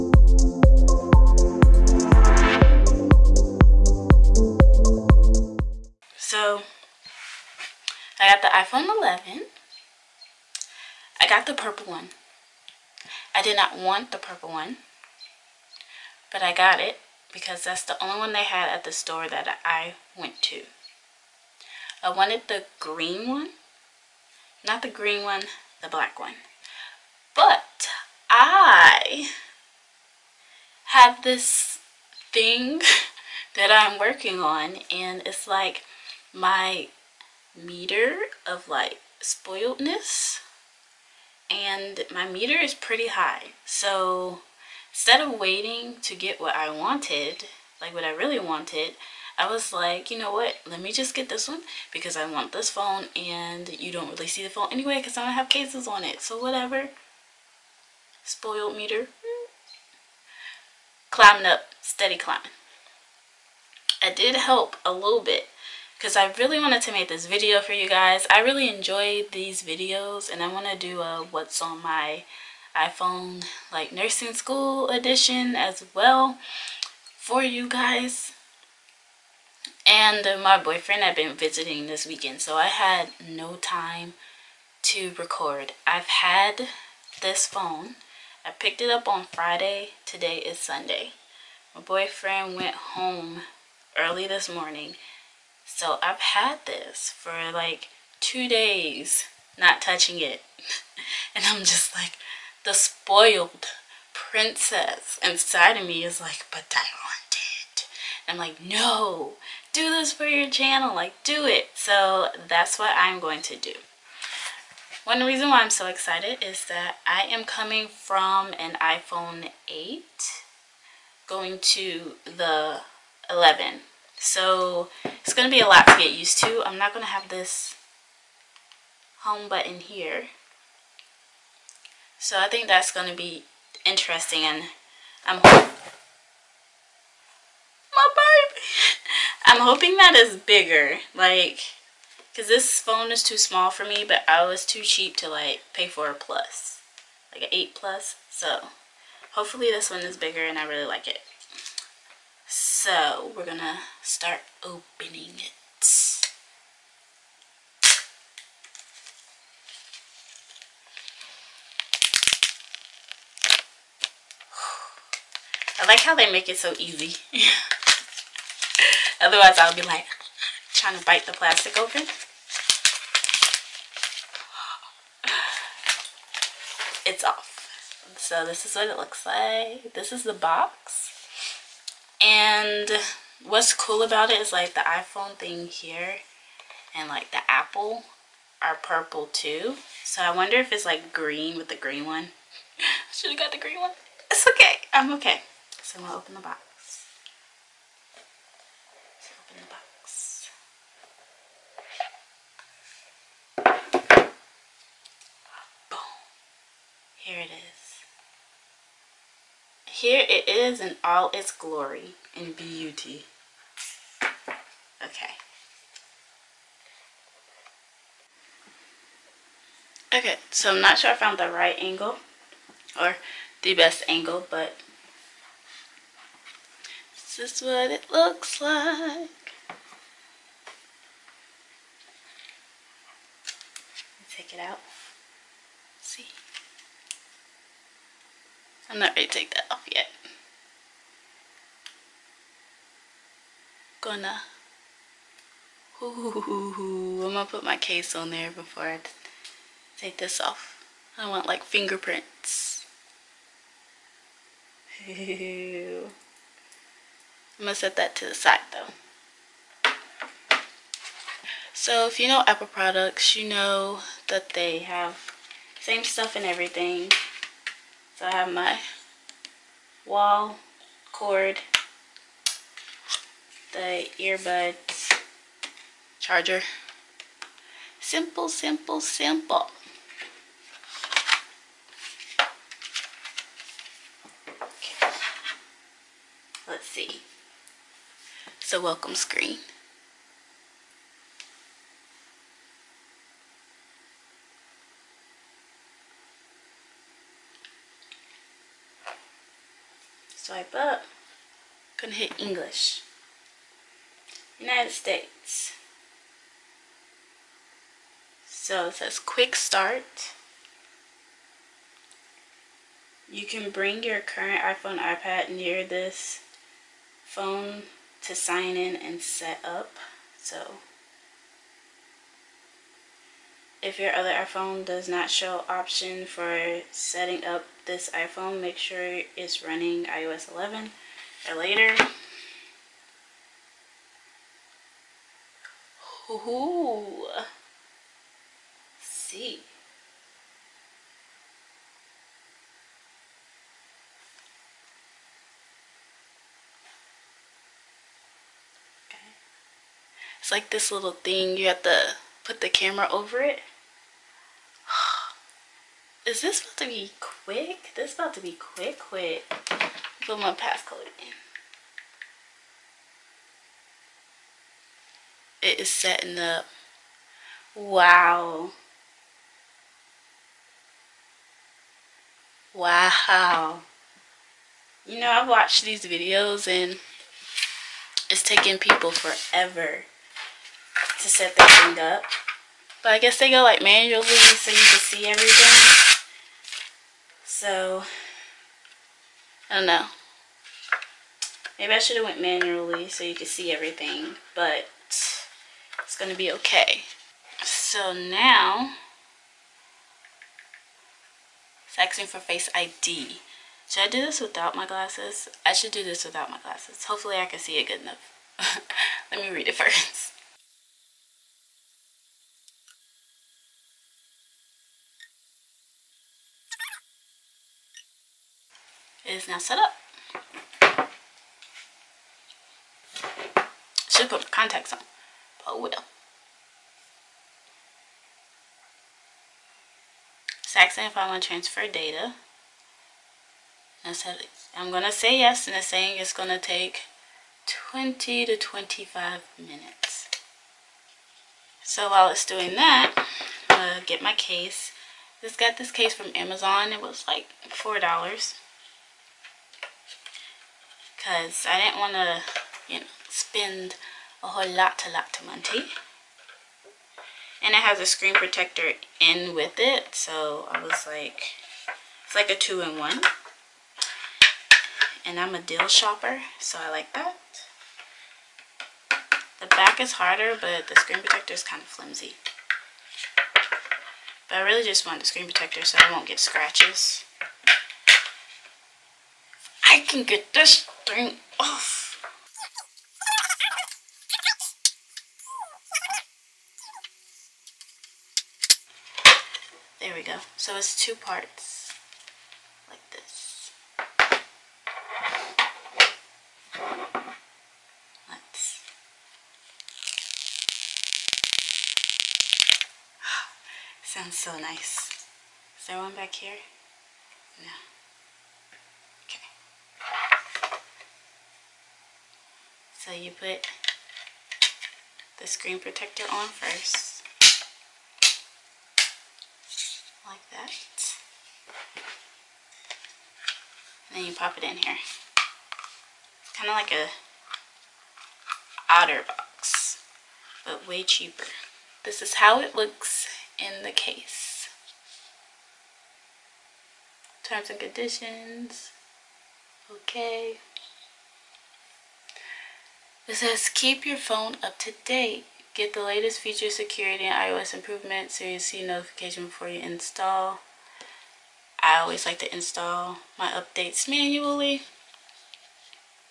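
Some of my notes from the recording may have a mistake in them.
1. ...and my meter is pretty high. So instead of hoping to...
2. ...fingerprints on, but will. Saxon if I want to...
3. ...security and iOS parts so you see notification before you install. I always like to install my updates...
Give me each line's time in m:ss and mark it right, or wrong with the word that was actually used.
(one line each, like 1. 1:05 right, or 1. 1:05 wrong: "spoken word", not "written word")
1. 0:41 wrong: "waiting", not "hoping"
2. 7:04 wrong: "contacts", not "fingerprints"
3. 9:06 wrong: "improvements", not "parts".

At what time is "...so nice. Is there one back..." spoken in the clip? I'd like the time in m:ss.
8:24.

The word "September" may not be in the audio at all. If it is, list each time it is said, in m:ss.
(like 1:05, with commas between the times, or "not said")
not said.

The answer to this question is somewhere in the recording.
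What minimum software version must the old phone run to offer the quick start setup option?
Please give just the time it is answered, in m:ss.
5:30.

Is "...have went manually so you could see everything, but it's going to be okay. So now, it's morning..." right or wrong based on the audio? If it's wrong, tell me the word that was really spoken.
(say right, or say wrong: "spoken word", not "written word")
wrong: "asking", not "morning".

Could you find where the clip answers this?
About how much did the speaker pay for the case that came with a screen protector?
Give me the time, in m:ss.
7:27.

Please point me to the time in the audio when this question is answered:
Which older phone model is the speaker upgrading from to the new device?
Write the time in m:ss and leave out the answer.
1:58.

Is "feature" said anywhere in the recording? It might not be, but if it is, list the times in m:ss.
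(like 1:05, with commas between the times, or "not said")
9:06.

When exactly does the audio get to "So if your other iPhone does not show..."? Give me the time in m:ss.
5:20.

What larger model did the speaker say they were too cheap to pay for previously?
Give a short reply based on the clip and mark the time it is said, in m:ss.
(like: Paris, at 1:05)
8 Plus, at 2:27.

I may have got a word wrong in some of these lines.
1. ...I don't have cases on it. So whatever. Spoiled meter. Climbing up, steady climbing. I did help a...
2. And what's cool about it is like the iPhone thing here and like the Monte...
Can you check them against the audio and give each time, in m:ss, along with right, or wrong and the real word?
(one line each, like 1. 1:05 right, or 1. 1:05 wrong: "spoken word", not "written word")
1. 0:55 right
2. 3:02 wrong: "Apple", not "Monte".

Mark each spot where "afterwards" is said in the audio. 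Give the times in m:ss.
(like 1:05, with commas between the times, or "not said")
not said.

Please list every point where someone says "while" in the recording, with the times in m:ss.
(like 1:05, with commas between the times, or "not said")
7:22.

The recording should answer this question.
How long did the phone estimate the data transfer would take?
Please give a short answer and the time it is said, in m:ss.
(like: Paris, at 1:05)
20 to 25 minutes, at 7:17.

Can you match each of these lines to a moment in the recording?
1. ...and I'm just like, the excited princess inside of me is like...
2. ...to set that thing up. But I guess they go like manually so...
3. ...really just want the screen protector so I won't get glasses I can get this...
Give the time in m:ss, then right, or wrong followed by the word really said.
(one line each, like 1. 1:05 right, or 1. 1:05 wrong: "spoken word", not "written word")
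1. 1:41 wrong: "spoiled", not "excited"
2. 6:21 right
3. 7:54 wrong: "scratches", not "glasses".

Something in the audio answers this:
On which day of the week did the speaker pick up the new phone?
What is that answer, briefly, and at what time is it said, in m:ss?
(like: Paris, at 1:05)
Friday, at 1:29.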